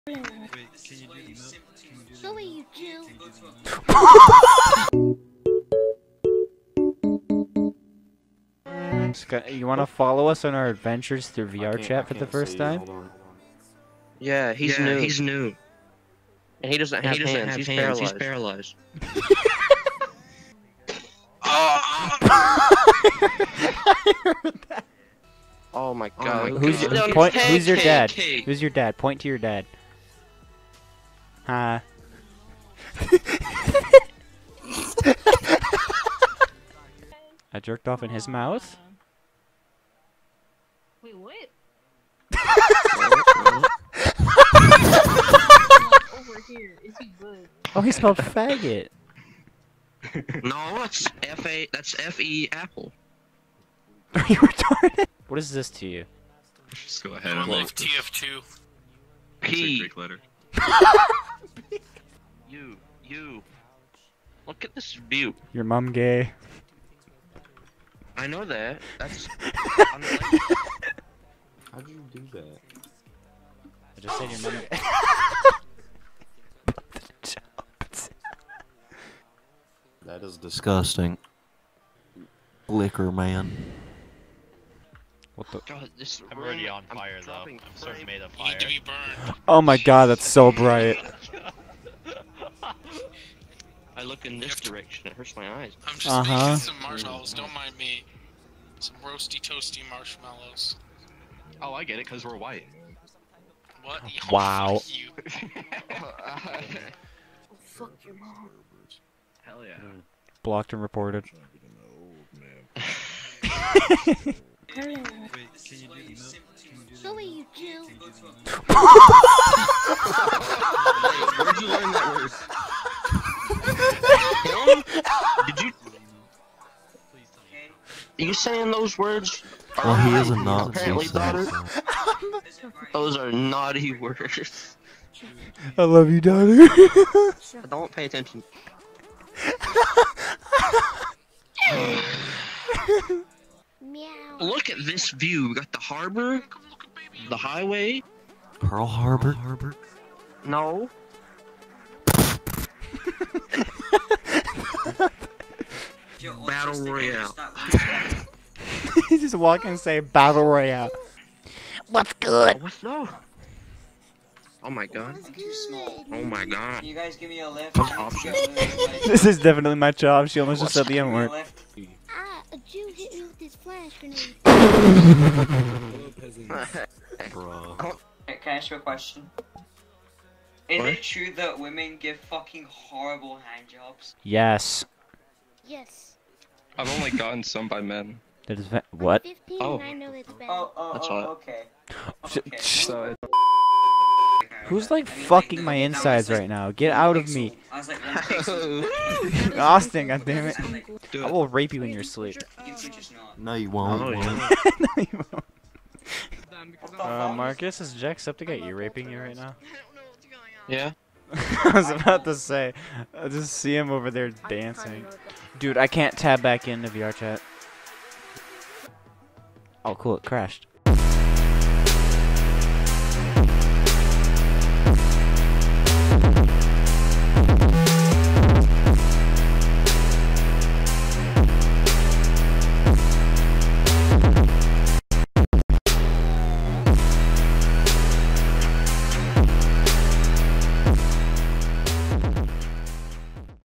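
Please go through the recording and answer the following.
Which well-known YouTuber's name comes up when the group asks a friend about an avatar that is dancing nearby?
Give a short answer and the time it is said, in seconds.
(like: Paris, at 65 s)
Jacksepticeye, at 207 s.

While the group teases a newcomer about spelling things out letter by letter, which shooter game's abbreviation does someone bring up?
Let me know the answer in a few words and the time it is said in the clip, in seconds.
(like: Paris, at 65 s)
TF2, at 57 s.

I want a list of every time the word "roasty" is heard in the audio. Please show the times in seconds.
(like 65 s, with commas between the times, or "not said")
99 s.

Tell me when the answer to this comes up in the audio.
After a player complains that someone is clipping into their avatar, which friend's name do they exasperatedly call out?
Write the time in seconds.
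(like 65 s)
199 s.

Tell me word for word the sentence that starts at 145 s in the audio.
We got the harbor, the highway.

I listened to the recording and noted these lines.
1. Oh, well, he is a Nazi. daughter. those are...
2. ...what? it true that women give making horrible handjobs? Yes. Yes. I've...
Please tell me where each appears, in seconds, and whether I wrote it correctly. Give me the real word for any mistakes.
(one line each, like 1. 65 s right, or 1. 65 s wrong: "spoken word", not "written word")
1. 129 s right
2. 180 s wrong: "fucking", not "making".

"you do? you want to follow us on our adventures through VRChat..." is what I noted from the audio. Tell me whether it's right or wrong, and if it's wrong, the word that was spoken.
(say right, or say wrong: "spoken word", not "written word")
right.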